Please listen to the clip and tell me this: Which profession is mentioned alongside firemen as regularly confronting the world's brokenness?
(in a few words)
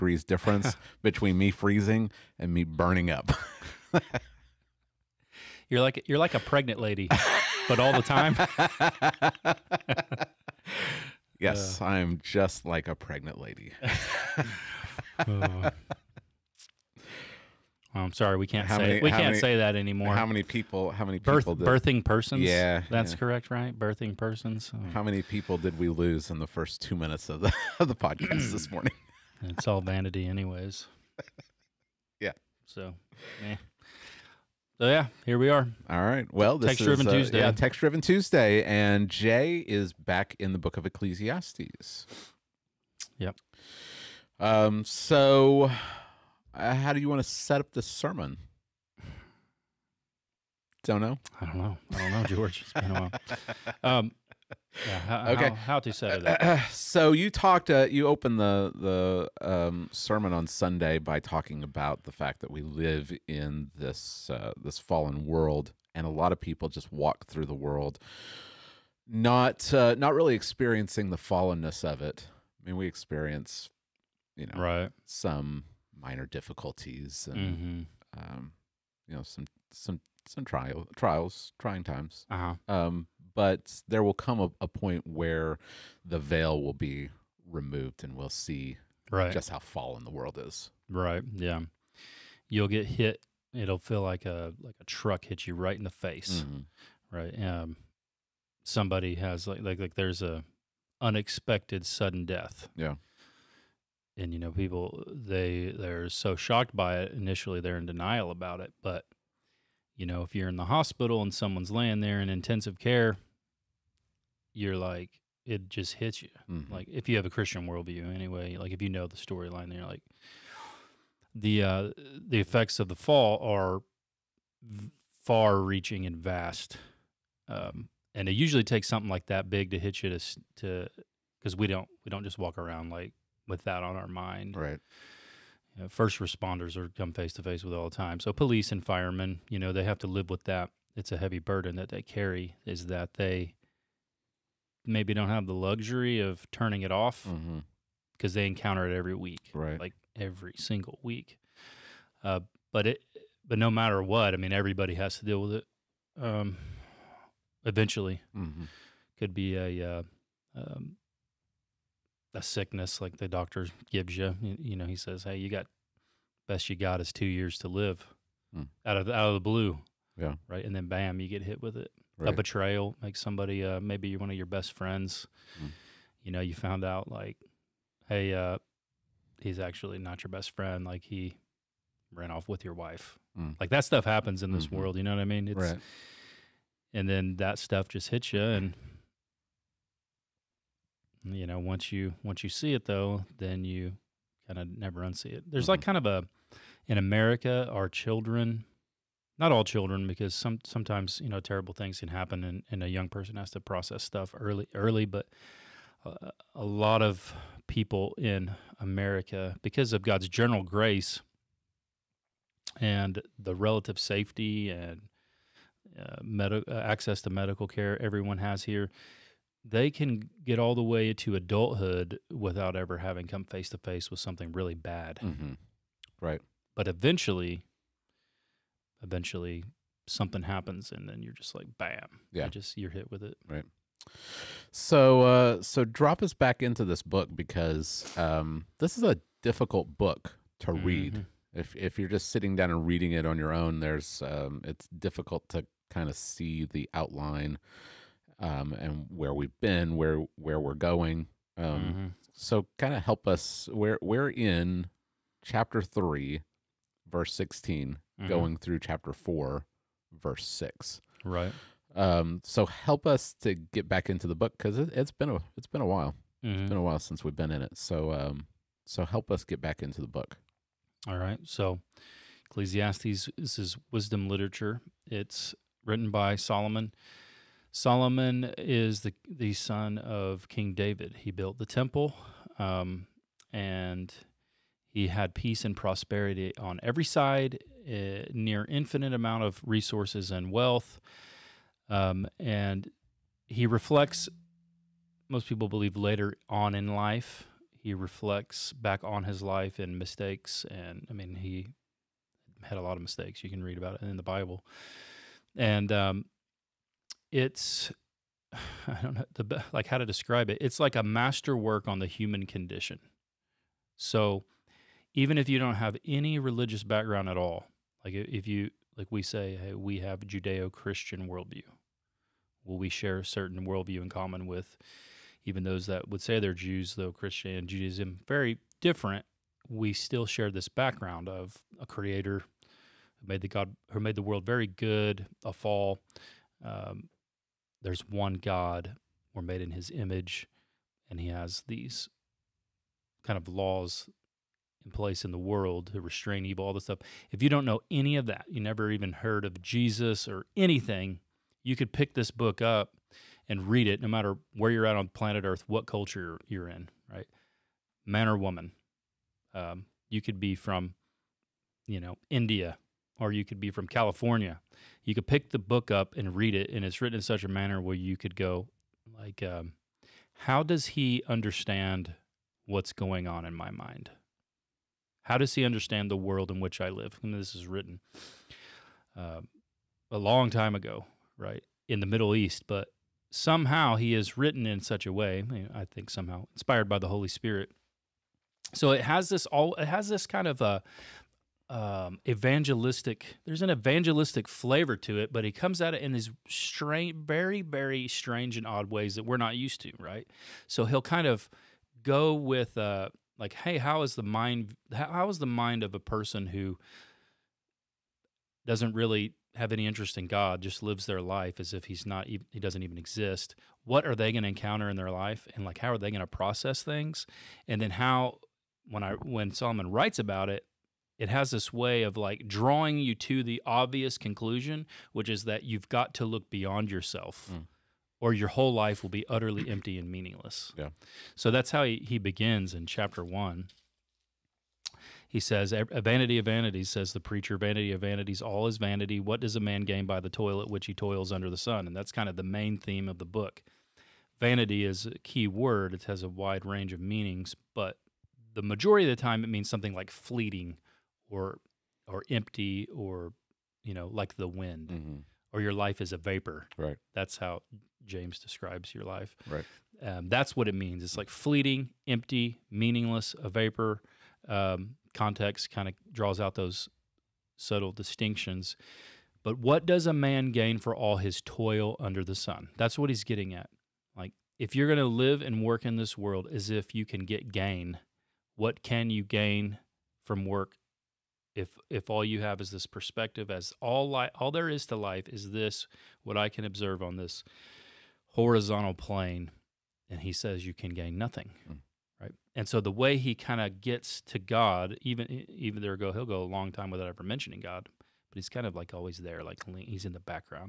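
police.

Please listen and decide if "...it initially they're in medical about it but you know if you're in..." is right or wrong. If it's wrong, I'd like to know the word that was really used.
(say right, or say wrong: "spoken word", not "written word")
wrong: "denial", not "medical".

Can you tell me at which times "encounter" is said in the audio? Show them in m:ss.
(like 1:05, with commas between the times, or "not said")
2:28, 6:54.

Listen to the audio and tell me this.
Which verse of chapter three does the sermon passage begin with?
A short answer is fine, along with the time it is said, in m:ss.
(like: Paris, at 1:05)
16, at 4:17.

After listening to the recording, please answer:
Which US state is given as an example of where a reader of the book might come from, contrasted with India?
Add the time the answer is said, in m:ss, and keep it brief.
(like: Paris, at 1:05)
California, at 6:03.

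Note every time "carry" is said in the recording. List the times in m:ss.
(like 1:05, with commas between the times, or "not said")
2:22.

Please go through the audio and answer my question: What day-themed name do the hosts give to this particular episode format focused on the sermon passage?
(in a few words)
Text driven Tuesday.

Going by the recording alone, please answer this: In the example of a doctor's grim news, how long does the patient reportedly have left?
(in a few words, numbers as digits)
2 years.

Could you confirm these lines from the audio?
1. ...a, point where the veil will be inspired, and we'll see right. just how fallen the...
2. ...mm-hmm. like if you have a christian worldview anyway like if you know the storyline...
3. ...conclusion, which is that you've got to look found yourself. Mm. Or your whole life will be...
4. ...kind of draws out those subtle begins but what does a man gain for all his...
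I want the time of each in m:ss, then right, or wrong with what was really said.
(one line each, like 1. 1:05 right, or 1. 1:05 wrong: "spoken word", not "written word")
1. 1:24 wrong: "removed", not "inspired"
2. 1:56 right
3. 7:04 wrong: "beyond", not "found"
4. 7:45 wrong: "distinctions", not "begins".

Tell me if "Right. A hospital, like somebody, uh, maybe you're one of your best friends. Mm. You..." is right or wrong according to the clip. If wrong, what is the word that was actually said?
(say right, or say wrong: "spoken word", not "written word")
wrong: "betrayal", not "hospital".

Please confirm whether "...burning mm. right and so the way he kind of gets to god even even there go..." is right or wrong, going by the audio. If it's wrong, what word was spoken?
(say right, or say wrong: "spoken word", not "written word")
wrong: "nothing", not "burning".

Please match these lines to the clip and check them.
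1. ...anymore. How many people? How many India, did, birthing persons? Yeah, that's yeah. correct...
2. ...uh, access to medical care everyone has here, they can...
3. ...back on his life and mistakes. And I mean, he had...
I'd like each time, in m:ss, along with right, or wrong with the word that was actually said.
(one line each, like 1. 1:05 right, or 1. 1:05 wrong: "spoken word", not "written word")
1. 0:19 wrong: "Birth", not "India"
2. 3:36 right
3. 4:58 right.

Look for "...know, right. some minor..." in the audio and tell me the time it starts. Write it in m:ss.
1:14.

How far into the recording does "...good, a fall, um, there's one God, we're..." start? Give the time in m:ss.
5:34.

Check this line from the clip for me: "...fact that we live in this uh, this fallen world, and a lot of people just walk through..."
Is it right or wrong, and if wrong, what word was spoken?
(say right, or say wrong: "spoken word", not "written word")
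right.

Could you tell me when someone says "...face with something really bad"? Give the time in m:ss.
3:43.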